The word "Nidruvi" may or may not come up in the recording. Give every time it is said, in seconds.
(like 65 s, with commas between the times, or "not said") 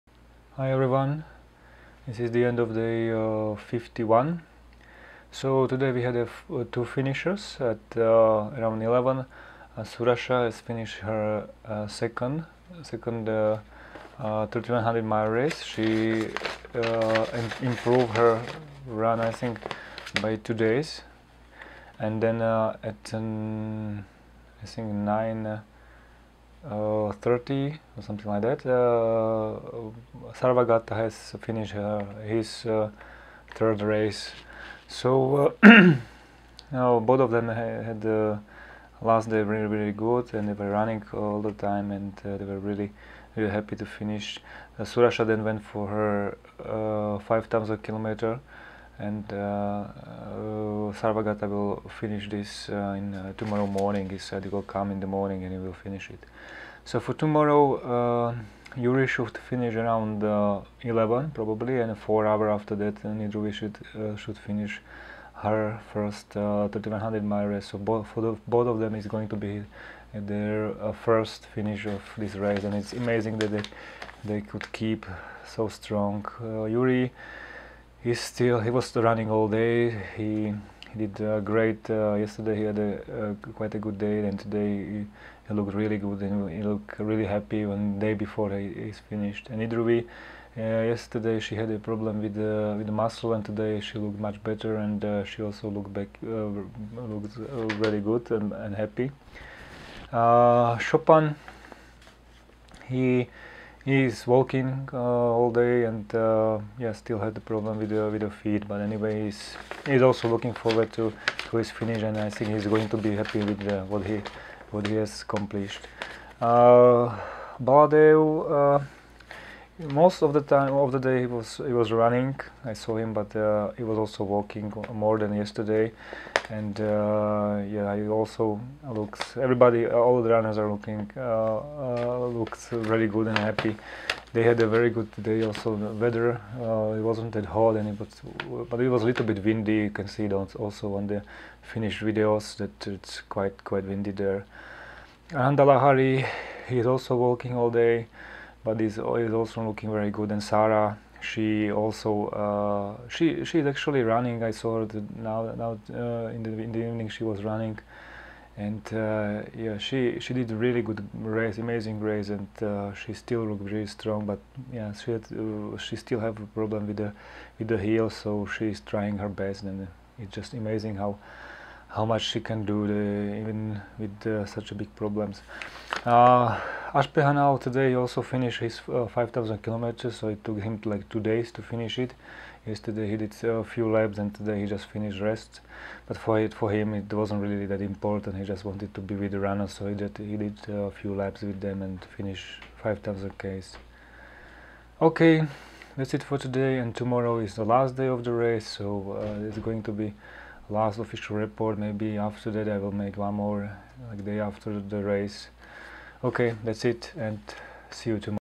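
63 s, 89 s.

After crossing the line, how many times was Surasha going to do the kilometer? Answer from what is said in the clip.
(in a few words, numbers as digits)
5.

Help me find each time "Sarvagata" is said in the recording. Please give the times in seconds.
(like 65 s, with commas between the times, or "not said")
30 s, 50 s.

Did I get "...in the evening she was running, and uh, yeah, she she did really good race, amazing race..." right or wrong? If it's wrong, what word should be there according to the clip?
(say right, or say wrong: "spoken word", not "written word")
right.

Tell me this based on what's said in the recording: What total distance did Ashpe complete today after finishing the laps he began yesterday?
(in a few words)
5000 kilometers.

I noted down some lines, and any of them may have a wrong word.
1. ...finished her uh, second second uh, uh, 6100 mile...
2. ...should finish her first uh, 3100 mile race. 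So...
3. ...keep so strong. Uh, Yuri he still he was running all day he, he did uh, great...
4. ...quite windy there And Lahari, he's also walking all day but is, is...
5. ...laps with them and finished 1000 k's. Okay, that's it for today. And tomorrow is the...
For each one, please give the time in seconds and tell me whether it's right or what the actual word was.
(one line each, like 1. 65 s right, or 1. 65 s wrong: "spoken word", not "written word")
1. 10 s wrong: "3100", not "6100"
2. 64 s right
3. 74 s right
4. 143 s right
5. 191 s wrong: "5000", not "1000".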